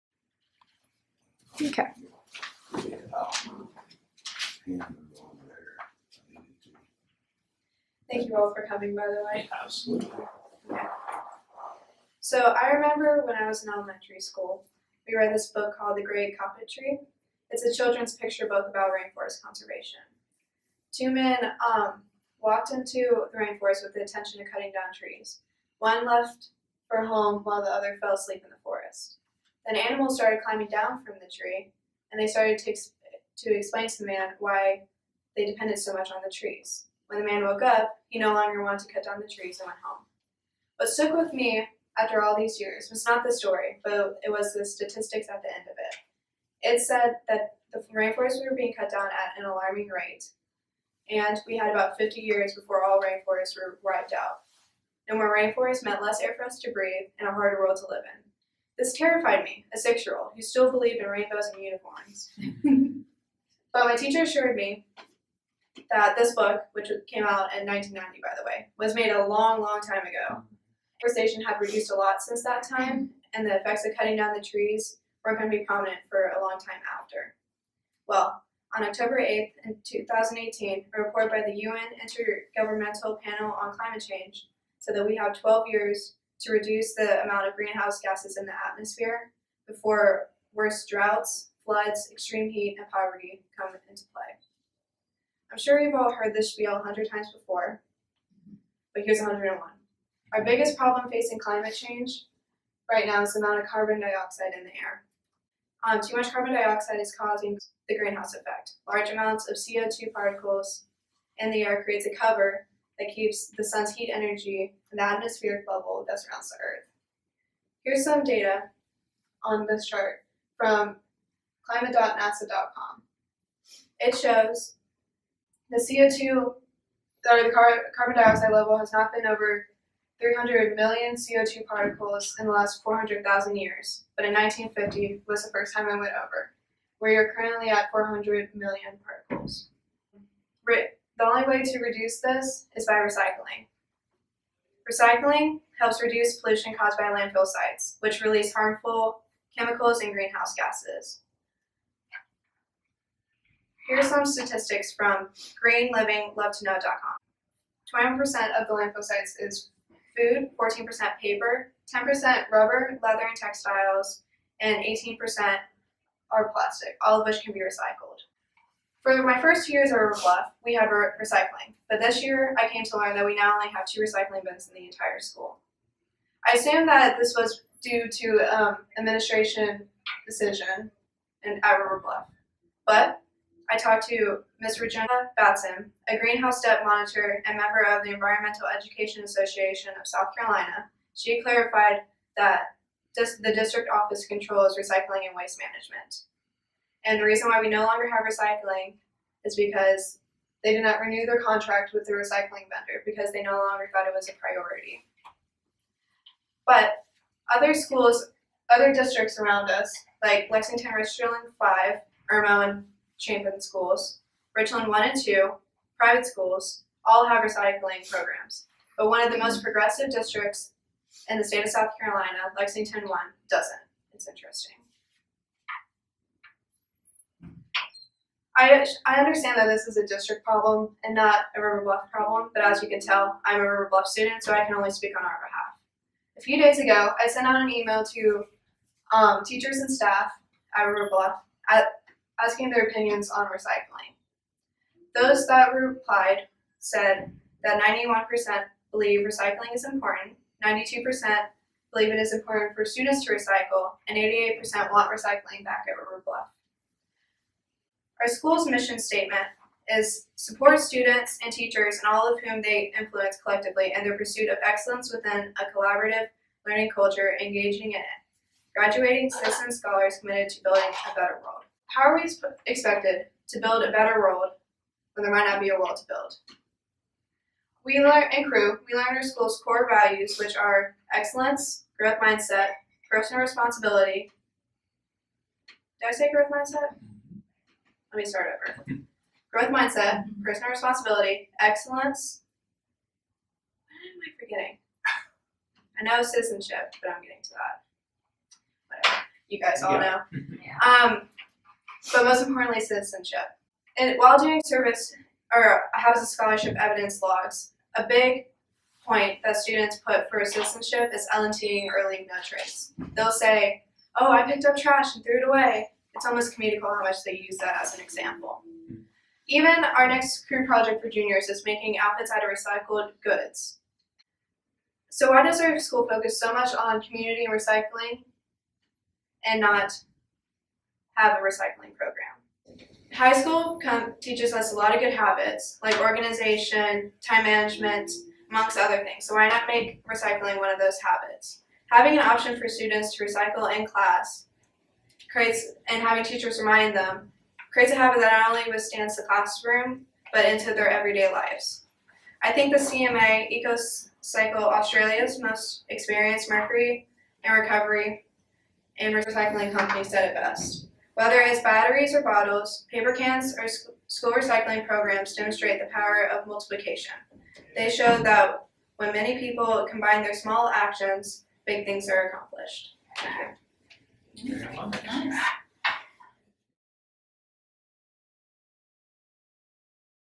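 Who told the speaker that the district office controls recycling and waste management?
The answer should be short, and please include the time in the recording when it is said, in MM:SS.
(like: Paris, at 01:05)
Regina Batson, at 03:04.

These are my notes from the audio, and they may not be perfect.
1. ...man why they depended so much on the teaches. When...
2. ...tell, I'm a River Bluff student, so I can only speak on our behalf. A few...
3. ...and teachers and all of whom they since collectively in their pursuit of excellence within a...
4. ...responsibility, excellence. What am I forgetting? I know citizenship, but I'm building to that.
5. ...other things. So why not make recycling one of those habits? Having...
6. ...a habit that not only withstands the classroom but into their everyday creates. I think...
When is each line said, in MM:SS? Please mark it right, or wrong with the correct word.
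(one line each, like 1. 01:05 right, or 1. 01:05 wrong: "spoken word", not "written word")
1. 00:34 wrong: "trees", not "teaches"
2. 03:52 right
3. 04:21 wrong: "influence", not "since"
4. 04:50 wrong: "getting", not "building"
5. 05:38 right
6. 05:47 wrong: "lives", not "creates".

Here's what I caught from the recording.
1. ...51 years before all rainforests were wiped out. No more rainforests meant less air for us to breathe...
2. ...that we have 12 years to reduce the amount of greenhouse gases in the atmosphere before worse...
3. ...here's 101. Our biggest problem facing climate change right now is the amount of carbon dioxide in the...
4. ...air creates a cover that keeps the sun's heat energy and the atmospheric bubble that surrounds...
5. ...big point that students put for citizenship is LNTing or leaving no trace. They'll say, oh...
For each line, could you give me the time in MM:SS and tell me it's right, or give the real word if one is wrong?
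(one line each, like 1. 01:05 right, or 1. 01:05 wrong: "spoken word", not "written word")
1. 00:51 wrong: "50", not "51"
2. 01:24 right
3. 01:39 right
4. 01:51 right
5. 05:08 right.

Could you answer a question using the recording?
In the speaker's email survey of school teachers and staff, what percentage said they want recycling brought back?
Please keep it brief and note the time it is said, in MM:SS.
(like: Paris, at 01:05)
88%, at 04:14.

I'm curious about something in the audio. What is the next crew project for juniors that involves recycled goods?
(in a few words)
making outfits.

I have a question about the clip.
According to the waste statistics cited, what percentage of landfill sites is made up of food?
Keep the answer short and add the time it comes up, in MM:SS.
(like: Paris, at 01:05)
21%, at 02:37.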